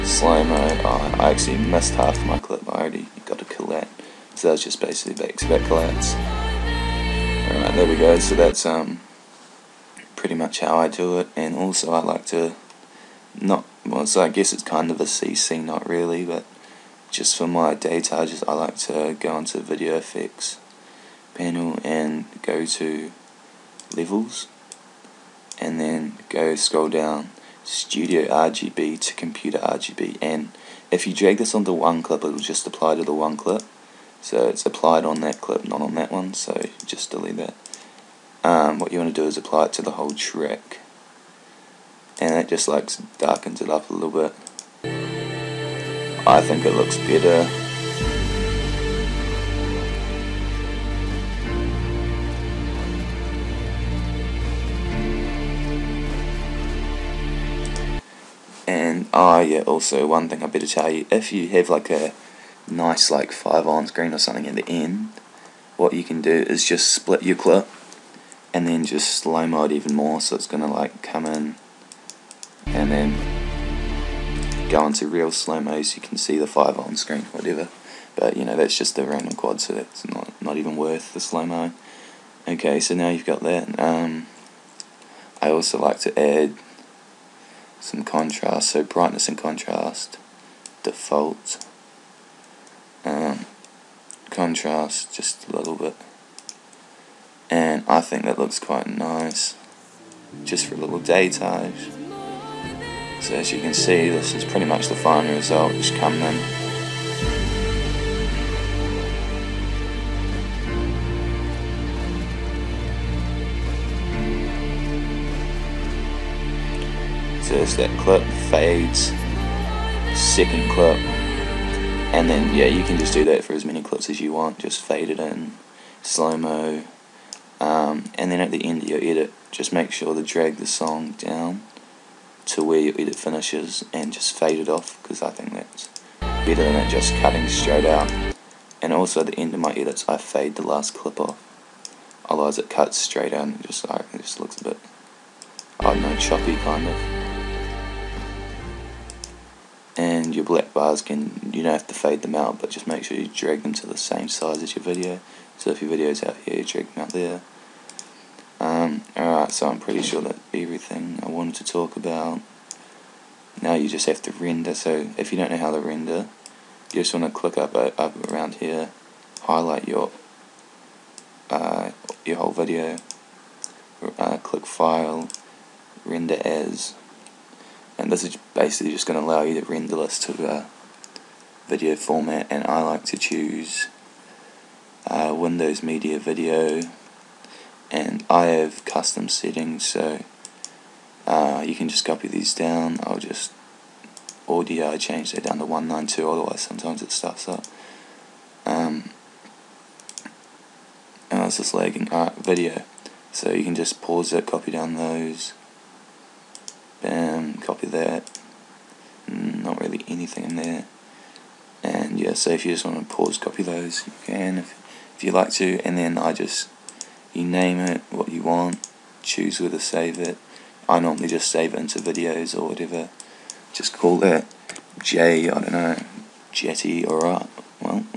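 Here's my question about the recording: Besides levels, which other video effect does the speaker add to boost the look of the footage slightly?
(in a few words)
Brightness and contrast.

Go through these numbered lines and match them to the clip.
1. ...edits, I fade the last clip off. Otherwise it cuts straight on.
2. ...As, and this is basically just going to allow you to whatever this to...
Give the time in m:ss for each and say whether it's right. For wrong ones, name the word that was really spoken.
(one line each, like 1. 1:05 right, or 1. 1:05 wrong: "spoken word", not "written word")
1. 2:19 right
2. 2:56 wrong: "render", not "whatever".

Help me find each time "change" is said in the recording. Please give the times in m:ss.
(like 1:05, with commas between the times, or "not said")
3:14.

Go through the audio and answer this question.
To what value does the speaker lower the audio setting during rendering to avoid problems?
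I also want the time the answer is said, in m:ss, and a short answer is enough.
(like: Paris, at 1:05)
192, at 3:15.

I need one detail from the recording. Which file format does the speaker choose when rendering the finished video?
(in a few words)
Windows Media Video.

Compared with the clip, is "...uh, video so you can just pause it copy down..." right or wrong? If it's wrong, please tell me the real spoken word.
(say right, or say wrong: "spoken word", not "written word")
right.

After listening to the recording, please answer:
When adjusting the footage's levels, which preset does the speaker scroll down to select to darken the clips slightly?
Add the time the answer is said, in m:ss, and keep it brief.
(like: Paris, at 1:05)
Studio RGB to Computer RGB, at 0:27.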